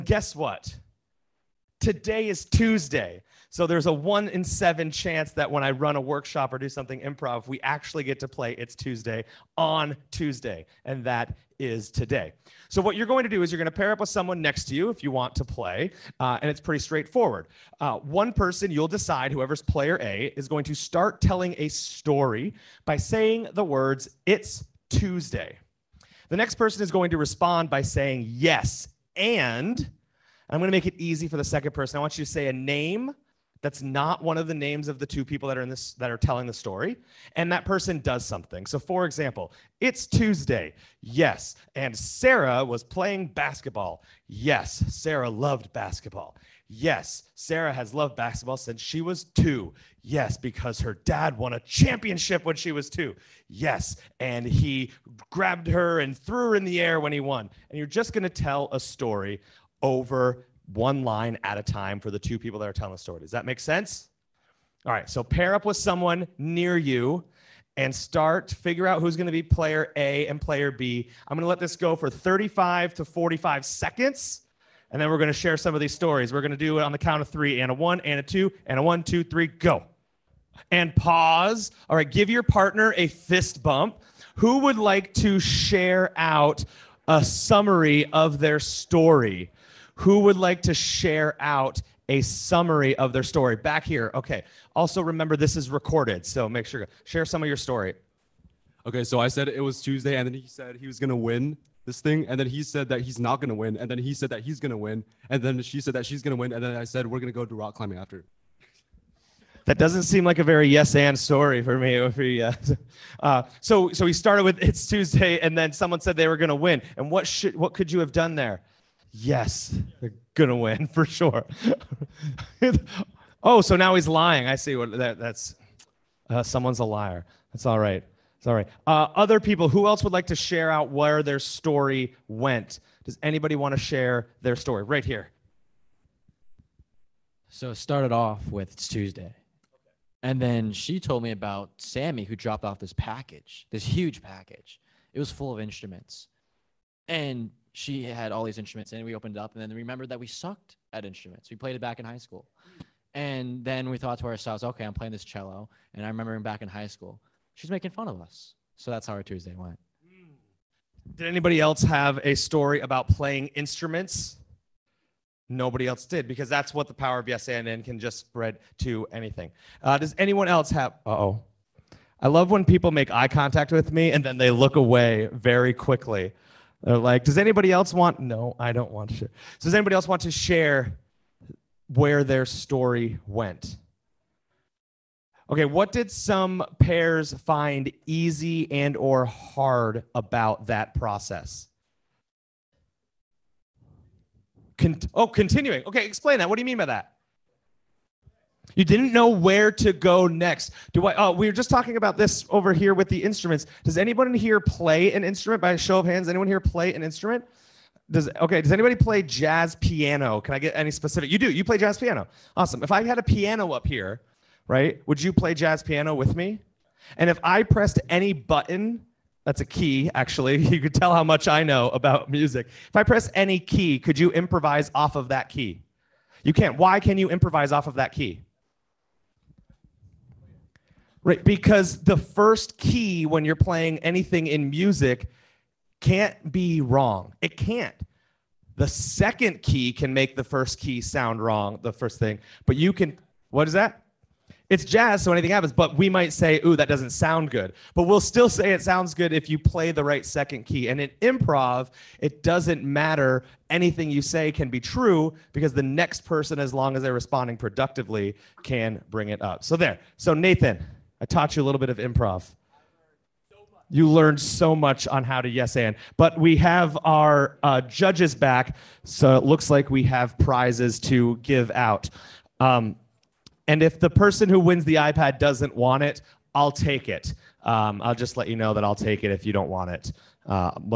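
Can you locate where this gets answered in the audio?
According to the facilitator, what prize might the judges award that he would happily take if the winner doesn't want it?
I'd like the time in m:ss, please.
4:34.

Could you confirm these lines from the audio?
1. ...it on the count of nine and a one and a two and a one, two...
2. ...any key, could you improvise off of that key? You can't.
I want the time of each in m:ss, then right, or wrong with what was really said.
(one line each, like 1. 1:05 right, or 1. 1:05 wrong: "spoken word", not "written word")
1. 1:16 wrong: "three", not "nine"
2. 3:43 right.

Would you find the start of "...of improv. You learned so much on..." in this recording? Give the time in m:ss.
4:21.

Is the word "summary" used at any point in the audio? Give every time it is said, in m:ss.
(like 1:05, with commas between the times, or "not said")
1:27, 1:32.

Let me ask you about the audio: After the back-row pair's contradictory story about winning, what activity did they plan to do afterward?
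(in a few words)
rock climbing.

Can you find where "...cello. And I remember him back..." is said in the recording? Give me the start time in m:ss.
2:35.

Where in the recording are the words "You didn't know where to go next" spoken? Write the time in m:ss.
3:18.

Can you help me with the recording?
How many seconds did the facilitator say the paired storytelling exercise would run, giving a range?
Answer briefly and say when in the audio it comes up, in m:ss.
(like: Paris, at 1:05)
35 to 45 seconds, at 1:12.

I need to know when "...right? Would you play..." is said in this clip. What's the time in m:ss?
3:34.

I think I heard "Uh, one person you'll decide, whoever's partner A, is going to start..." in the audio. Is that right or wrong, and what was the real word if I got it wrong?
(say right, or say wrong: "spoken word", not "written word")
wrong: "player", not "partner".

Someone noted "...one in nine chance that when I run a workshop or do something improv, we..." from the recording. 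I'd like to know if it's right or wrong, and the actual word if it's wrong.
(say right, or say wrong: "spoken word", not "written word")
wrong: "seven", not "nine".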